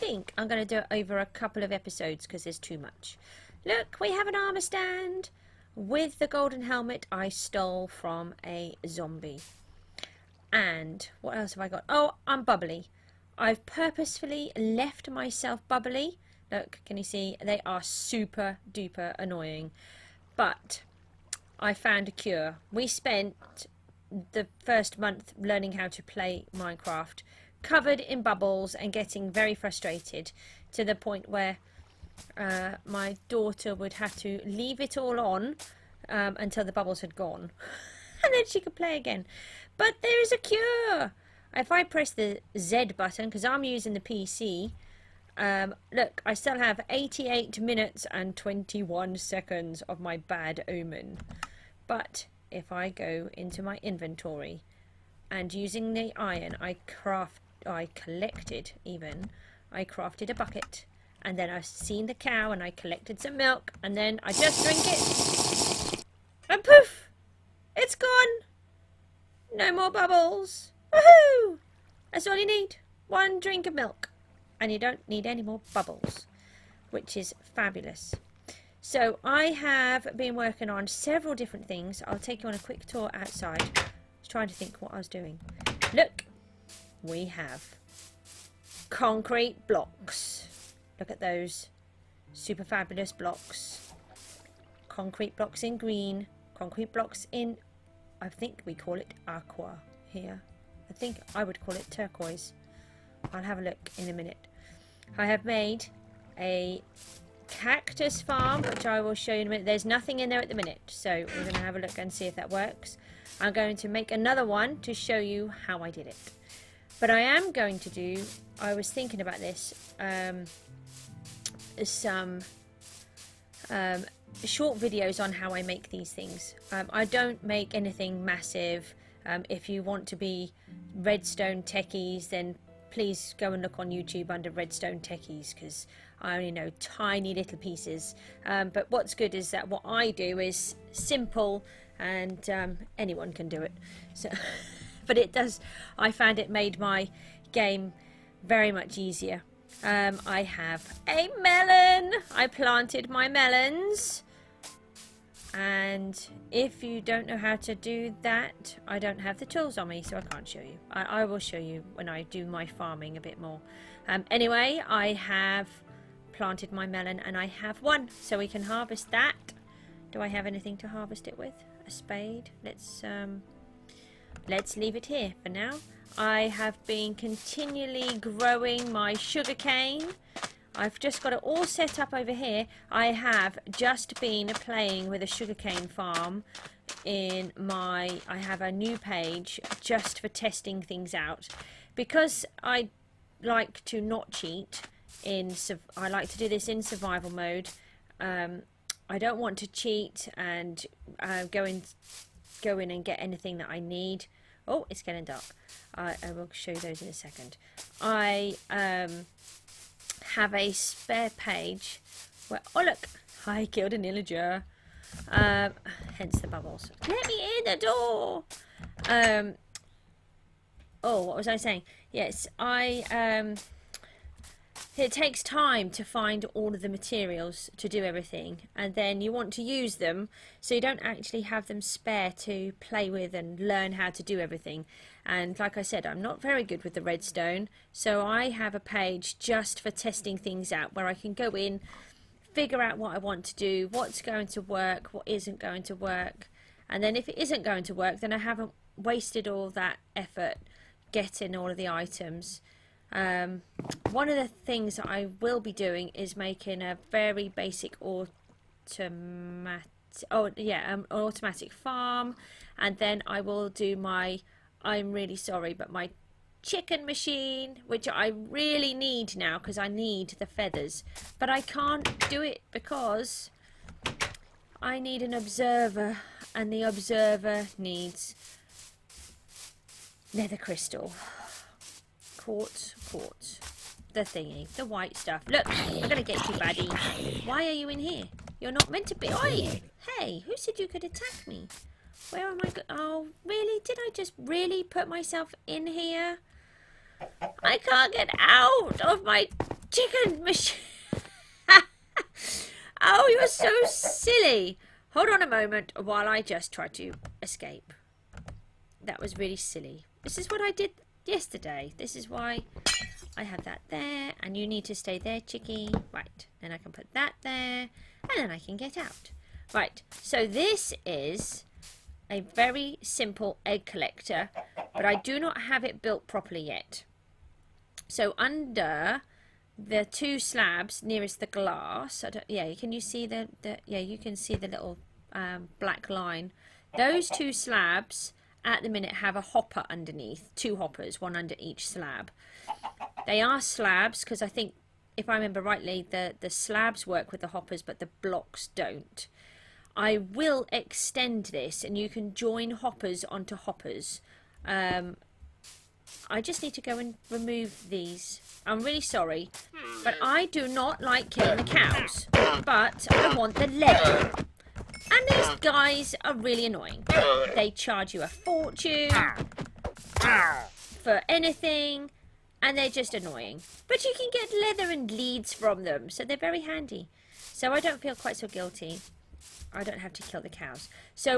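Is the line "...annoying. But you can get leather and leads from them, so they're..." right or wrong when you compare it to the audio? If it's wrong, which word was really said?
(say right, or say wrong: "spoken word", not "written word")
right.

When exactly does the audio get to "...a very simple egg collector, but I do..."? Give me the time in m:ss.
5:22.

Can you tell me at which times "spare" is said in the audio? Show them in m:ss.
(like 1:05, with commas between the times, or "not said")
3:30, 3:51.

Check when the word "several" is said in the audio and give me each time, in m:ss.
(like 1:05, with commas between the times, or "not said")
1:20.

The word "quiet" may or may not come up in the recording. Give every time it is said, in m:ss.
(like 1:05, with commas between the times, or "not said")
not said.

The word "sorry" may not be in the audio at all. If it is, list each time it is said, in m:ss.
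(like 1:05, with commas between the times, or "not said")
4:25, 5:59.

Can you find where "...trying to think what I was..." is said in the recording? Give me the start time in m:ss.
1:24.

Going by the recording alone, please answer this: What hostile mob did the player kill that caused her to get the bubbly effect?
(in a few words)
An illager.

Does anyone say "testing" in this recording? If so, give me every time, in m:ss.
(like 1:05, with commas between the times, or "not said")
3:10, 3:59.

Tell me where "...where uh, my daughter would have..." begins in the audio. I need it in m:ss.
0:31.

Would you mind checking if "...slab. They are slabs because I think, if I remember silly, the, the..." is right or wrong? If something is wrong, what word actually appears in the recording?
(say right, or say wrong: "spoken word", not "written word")
wrong: "rightly", not "silly".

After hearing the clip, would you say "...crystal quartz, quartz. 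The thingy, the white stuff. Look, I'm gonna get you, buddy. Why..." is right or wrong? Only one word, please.
right.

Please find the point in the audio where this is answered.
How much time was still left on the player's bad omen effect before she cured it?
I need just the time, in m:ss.
0:46.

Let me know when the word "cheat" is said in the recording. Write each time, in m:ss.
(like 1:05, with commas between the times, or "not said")
3:14, 3:19.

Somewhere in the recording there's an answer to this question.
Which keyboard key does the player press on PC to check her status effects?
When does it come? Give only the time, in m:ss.
0:42.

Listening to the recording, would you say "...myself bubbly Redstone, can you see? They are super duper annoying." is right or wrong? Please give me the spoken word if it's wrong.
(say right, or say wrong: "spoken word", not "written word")
wrong: "Look", not "Redstone".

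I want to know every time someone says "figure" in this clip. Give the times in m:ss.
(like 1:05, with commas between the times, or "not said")
4:02.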